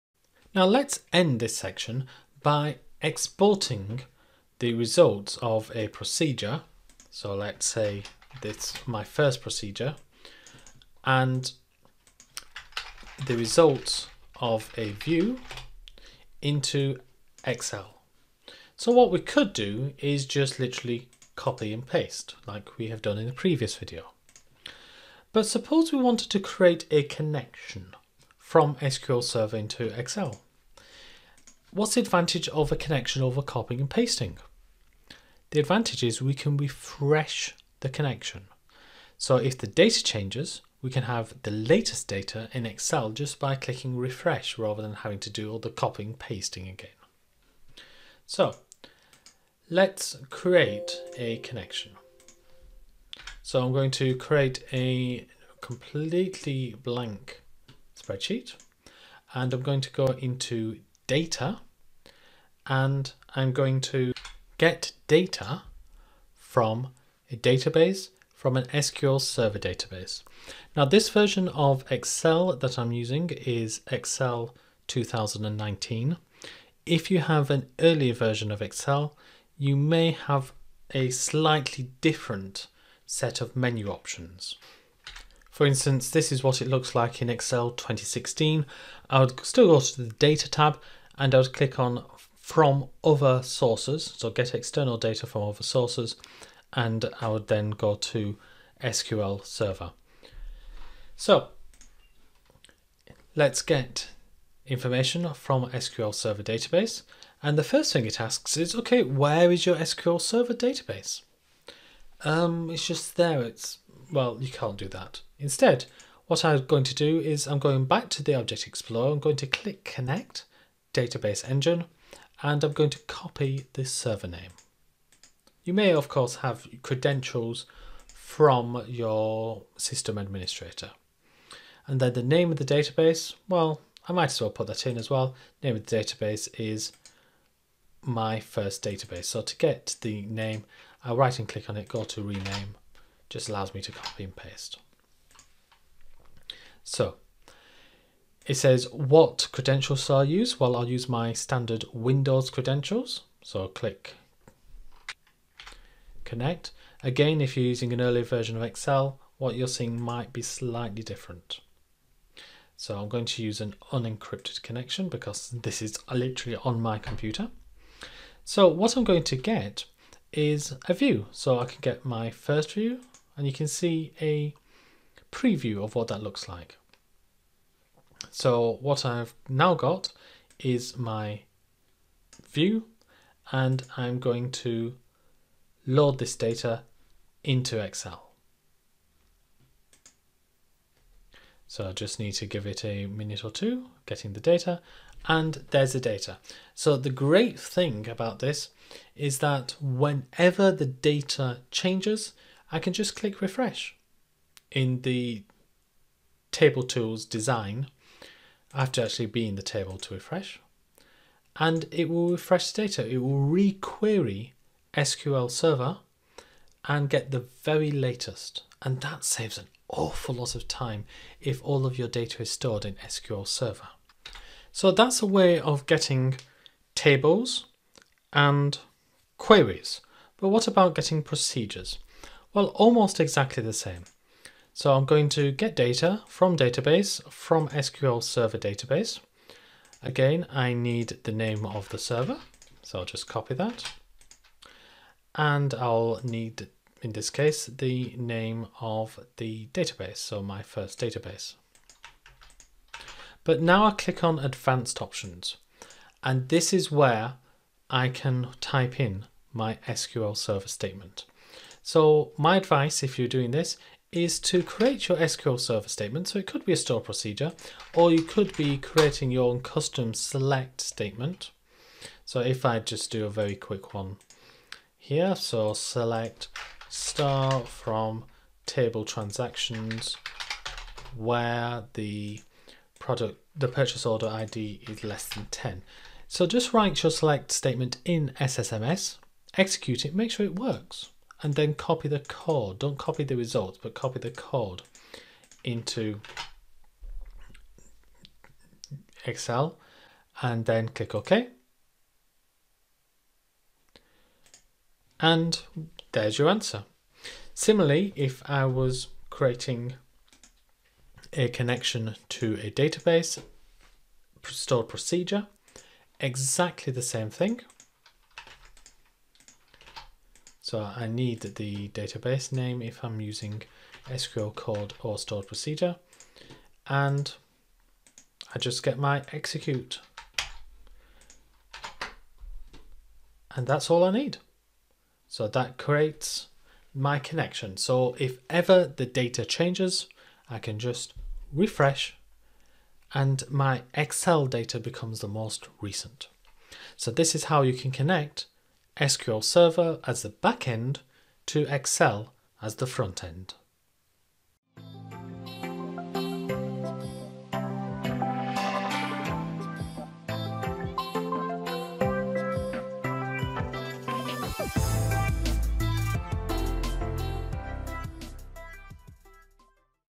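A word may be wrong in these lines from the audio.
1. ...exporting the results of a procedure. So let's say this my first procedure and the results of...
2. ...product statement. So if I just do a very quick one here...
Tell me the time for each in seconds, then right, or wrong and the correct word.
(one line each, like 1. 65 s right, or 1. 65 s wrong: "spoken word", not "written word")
1. 3 s right
2. 270 s wrong: "select", not "product".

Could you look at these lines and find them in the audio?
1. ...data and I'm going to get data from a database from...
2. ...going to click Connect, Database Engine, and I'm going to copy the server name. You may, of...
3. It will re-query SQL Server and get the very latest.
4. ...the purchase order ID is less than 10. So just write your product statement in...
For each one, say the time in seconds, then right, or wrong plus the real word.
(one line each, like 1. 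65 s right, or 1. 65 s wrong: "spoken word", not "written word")
1. 61 s right
2. 119 s right
3. 213 s right
4. 283 s wrong: "select", not "product".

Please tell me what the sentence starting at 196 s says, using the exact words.
So the great thing about this is that whenever the data changes, I can just click refresh.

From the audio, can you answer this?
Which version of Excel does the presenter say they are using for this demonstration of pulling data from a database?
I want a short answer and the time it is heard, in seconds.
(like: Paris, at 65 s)
Excel 2019, at 73 s.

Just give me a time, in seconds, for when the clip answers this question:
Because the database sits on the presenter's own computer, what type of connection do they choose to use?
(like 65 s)
163 s.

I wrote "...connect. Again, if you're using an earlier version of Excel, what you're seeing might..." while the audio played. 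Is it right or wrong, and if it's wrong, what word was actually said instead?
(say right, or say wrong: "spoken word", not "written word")
right.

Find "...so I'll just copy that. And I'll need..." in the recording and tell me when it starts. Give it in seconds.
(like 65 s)
242 s.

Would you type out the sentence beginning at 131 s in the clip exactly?
And then the name of the database, well, I might as well put that in as well.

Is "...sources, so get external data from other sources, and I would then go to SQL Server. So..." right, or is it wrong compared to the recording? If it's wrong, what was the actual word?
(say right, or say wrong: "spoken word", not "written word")
right.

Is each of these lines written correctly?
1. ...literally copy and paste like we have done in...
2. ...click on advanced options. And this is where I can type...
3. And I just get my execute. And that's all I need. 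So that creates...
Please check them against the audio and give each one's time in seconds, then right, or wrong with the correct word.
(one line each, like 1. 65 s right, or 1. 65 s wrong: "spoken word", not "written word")
1. 20 s right
2. 253 s right
3. 326 s right.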